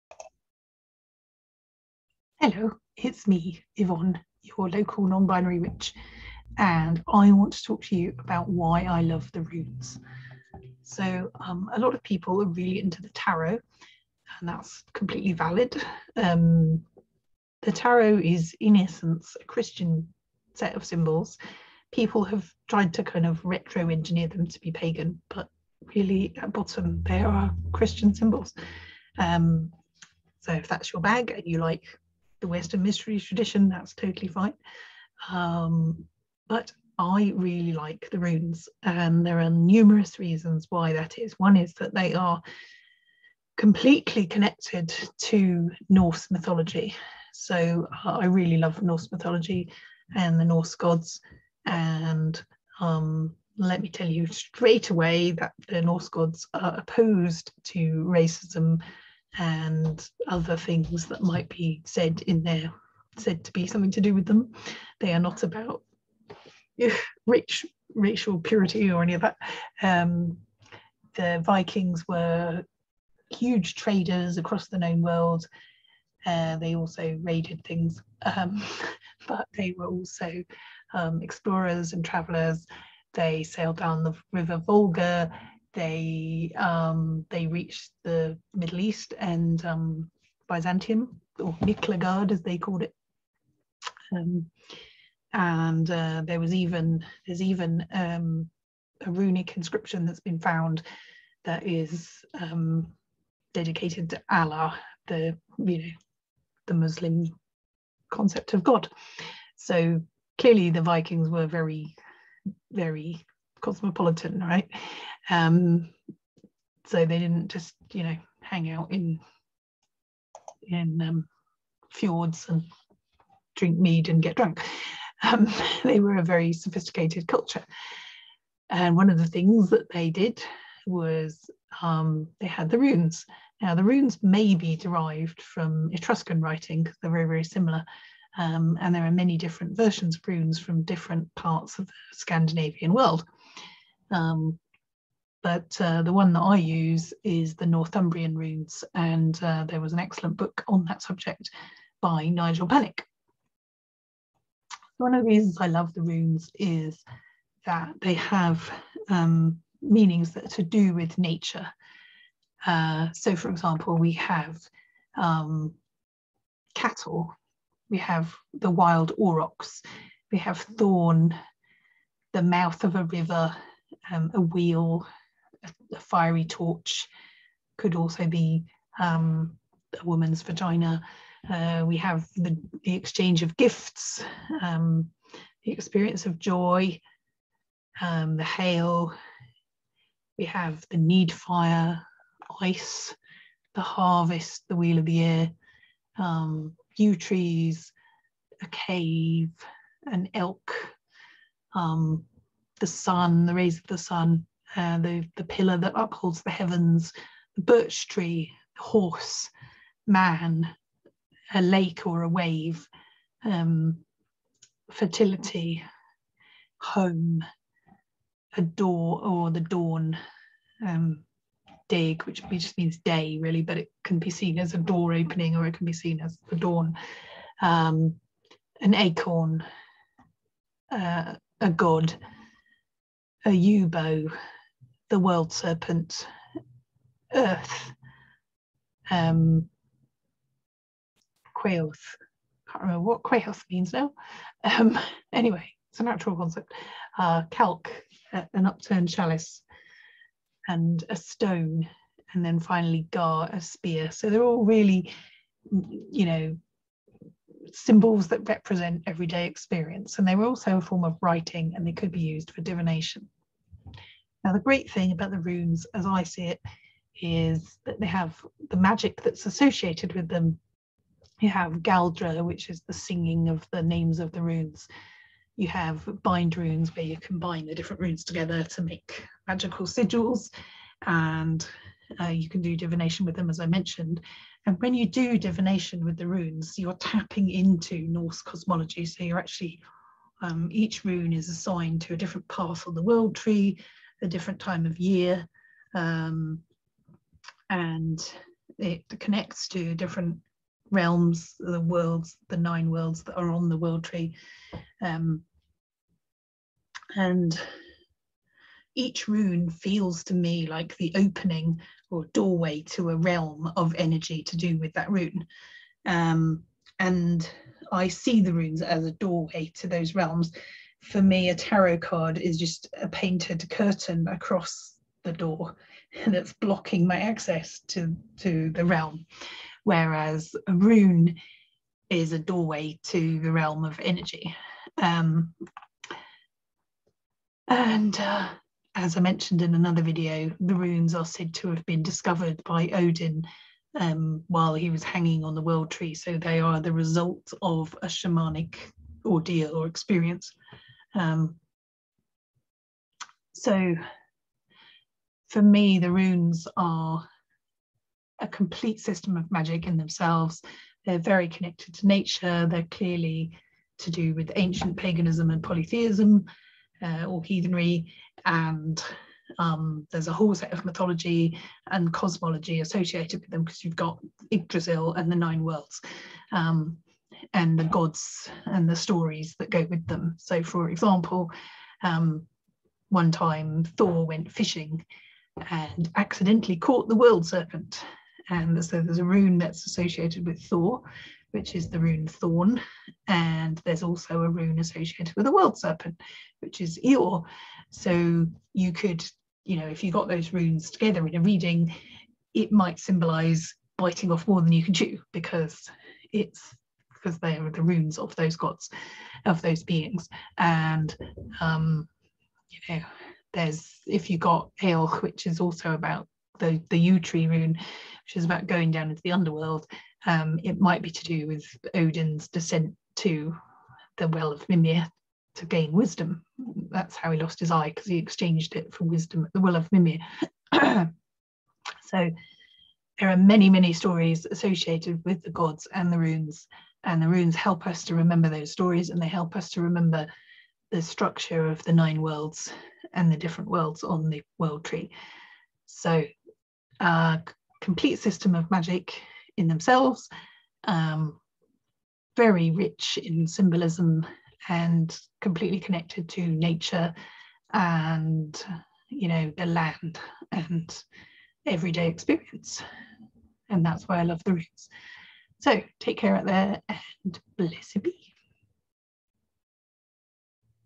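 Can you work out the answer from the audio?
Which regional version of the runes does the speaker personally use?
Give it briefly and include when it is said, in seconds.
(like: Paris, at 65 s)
Northumbrian runes, at 147 s.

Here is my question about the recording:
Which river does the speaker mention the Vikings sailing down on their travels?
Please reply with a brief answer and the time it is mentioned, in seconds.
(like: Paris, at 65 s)
Volga, at 84 s.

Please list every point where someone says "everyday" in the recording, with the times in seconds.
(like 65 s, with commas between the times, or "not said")
259 s, 461 s.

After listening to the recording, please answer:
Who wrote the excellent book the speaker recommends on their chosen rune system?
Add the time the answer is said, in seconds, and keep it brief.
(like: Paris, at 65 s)
Nigel Pennick, at 152 s.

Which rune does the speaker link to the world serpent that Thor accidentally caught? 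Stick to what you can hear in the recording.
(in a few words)
Eor.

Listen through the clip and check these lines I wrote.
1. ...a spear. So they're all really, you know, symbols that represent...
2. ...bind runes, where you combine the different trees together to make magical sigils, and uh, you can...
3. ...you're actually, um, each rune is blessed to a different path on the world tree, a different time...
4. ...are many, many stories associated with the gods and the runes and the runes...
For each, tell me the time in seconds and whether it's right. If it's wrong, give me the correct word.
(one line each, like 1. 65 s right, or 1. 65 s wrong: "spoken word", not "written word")
1. 253 s right
2. 276 s wrong: "runes", not "trees"
3. 289 s wrong: "assigned", not "blessed"
4. 433 s right.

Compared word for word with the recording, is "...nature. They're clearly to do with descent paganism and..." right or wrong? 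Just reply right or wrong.
wrong.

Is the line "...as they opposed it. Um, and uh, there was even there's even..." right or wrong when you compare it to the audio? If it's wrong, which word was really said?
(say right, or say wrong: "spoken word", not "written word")
wrong: "called", not "opposed".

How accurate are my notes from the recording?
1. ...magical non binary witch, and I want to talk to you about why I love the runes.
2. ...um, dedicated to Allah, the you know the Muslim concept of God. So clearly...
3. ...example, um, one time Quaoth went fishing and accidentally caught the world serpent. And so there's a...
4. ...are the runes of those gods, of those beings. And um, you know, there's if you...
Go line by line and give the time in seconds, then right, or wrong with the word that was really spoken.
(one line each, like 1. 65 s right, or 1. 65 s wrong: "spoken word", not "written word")
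1. 4 s wrong: "local", not "magical"
2. 102 s right
3. 380 s wrong: "Thor", not "Quaoth"
4. 407 s right.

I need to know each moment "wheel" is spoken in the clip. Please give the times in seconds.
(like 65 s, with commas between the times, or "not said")
174 s, 194 s.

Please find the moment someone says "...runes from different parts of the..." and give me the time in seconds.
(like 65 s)
140 s.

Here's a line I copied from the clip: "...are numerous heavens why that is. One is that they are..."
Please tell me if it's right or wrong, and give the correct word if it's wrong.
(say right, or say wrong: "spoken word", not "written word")
wrong: "reasons", not "heavens".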